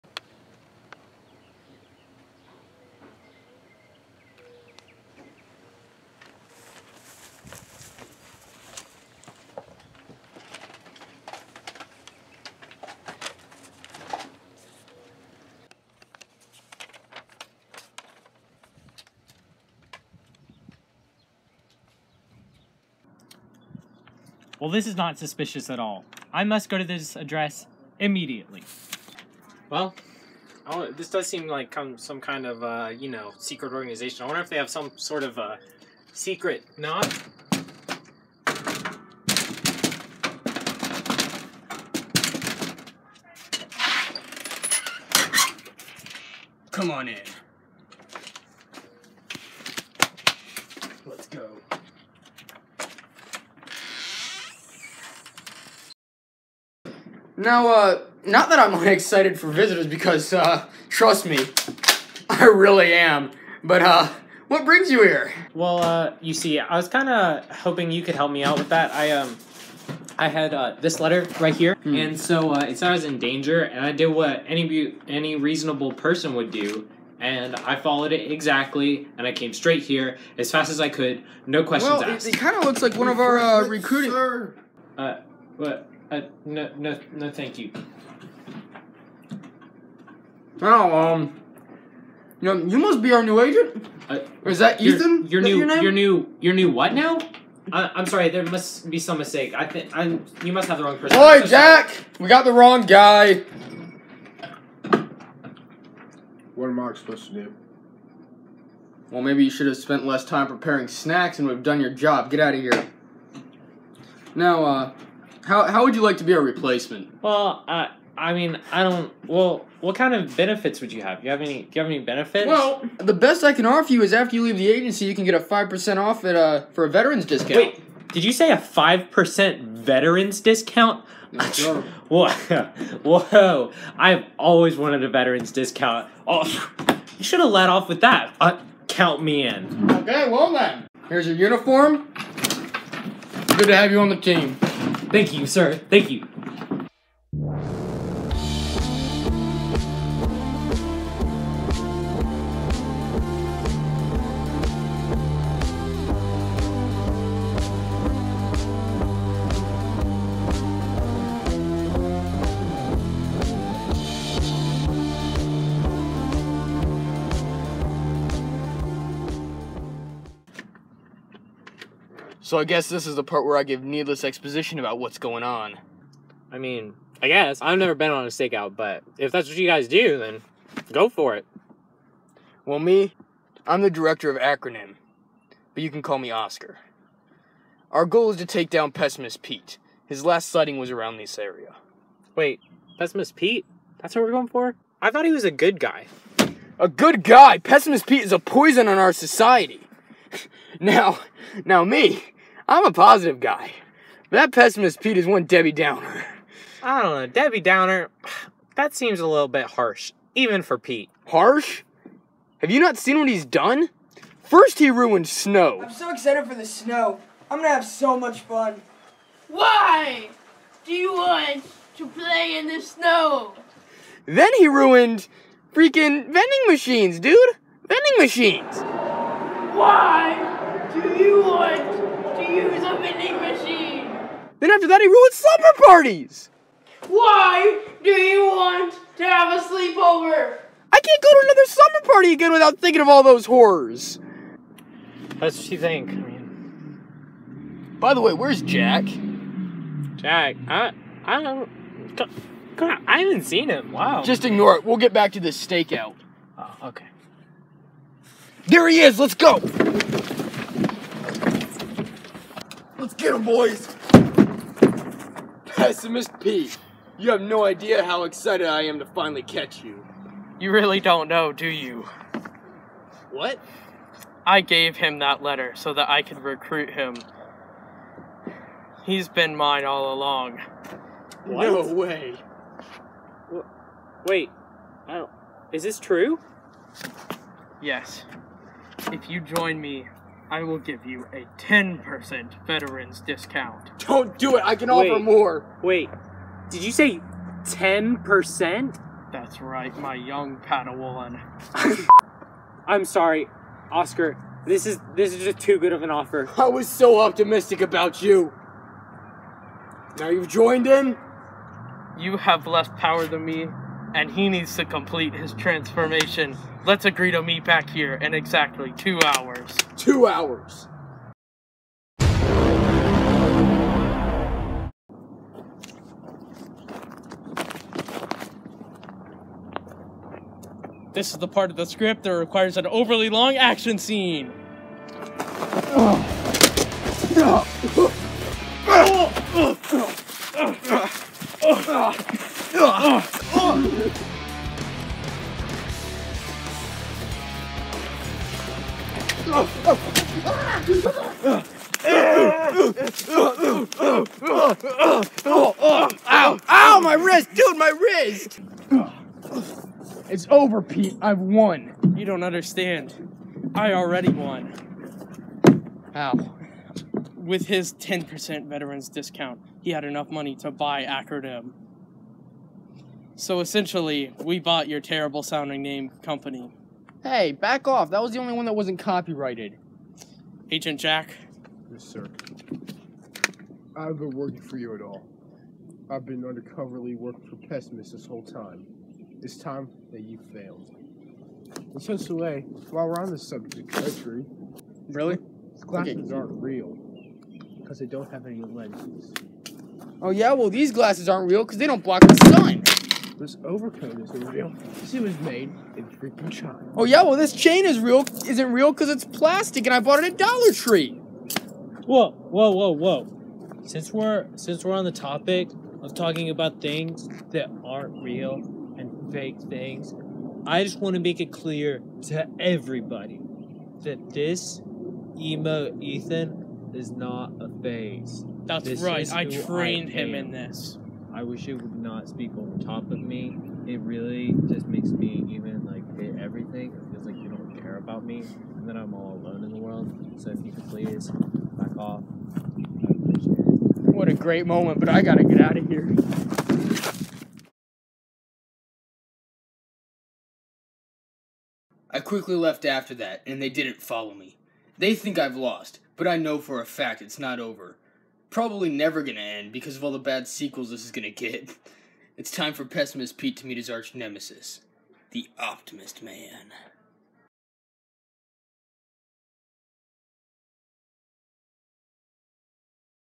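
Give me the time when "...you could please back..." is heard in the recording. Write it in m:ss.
7:20.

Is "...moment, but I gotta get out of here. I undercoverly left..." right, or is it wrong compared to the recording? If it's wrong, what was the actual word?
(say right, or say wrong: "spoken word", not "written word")
wrong: "quickly", not "undercoverly".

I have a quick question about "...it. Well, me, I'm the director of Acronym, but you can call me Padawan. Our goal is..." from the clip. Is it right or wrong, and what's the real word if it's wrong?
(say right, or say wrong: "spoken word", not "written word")
wrong: "Oscar", not "Padawan".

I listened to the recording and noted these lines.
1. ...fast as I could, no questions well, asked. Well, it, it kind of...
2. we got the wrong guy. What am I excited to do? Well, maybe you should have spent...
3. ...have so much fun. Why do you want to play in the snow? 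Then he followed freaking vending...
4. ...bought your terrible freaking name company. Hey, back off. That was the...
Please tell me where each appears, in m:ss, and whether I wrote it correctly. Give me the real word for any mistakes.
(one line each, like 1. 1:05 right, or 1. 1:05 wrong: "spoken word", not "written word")
1. 1:20 right
2. 1:42 wrong: "supposed", not "excited"
3. 3:37 wrong: "ruined", not "followed"
4. 6:14 wrong: "sounding", not "freaking".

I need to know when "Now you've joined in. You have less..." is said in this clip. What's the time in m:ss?
5:10.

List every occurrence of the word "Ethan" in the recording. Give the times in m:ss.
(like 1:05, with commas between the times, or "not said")
1:34, 7:05.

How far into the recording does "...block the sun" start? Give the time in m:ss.
6:42.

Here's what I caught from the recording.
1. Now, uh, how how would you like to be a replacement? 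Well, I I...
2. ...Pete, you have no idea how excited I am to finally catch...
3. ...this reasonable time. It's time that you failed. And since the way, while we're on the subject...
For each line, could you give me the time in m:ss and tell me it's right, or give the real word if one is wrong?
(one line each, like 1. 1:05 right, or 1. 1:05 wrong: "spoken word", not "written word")
1. 1:54 right
2. 4:26 right
3. 6:28 wrong: "whole", not "reasonable".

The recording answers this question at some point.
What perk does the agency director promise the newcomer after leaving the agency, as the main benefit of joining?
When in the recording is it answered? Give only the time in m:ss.
2:08.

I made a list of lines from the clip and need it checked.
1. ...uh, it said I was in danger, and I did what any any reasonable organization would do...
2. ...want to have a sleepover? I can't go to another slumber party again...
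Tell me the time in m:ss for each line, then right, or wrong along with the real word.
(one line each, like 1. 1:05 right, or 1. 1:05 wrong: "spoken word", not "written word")
1. 1:12 wrong: "person", not "organization"
2. 3:58 right.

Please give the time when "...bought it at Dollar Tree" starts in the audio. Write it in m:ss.
6:49.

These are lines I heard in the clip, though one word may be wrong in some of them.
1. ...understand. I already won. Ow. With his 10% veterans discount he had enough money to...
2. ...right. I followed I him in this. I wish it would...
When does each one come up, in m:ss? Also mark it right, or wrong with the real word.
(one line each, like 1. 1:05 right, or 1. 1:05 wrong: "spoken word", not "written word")
1. 6:02 right
2. 7:09 wrong: "trained", not "followed".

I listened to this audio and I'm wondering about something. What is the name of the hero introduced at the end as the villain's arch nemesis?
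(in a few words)
Optimist Man.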